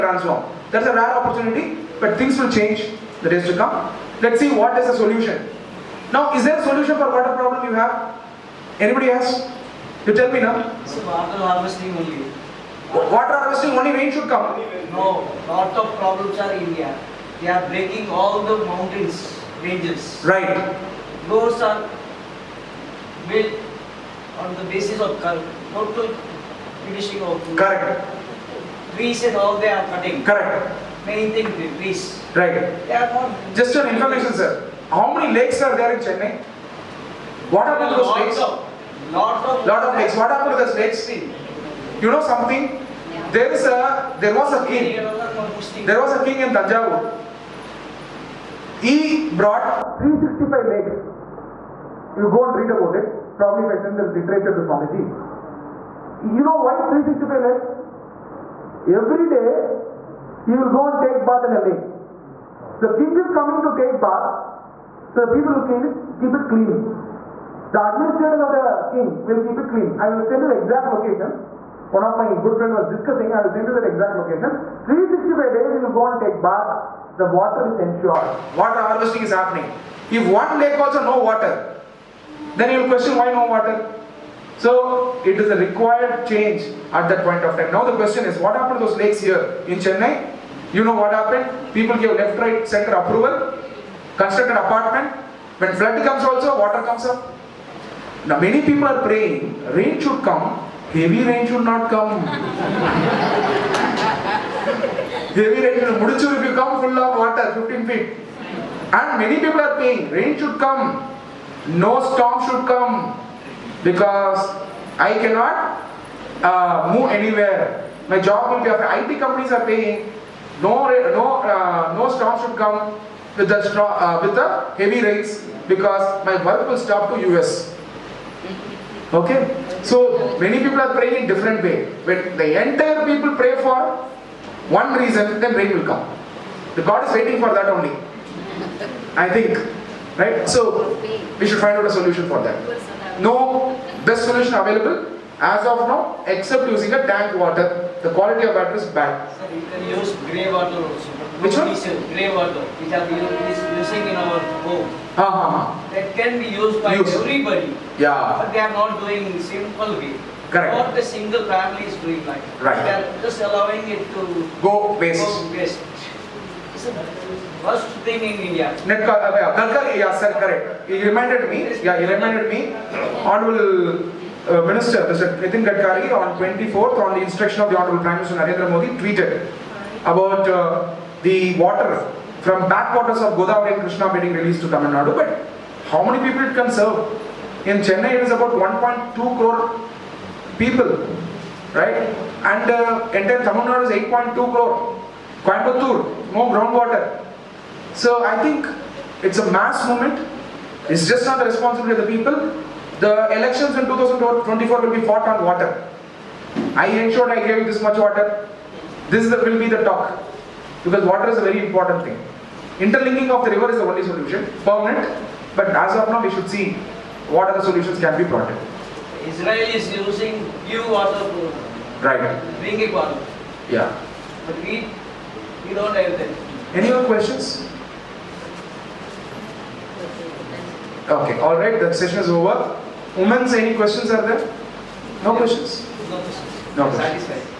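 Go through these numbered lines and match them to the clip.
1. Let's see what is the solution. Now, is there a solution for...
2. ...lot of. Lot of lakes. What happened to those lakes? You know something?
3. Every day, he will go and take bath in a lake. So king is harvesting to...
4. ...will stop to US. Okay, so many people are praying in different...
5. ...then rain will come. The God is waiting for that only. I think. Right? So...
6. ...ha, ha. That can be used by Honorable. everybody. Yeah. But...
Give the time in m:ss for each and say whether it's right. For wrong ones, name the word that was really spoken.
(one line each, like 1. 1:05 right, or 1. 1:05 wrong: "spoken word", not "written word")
1. 0:04 right
2. 0:39 right
3. 0:58 wrong: "coming", not "harvesting"
4. 2:06 right
5. 2:15 right
6. 2:35 wrong: "Use", not "Honorable".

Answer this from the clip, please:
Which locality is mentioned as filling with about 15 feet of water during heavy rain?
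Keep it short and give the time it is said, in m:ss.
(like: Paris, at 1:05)
Mudichur, at 1:46.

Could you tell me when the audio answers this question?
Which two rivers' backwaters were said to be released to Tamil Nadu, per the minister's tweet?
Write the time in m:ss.
3:03.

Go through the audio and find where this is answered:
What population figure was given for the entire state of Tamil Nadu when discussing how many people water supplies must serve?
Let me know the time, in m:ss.
3:14.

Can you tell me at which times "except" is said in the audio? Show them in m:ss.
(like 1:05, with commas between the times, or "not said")
2:26.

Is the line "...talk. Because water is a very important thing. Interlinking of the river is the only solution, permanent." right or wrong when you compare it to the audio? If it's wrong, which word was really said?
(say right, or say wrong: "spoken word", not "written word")
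right.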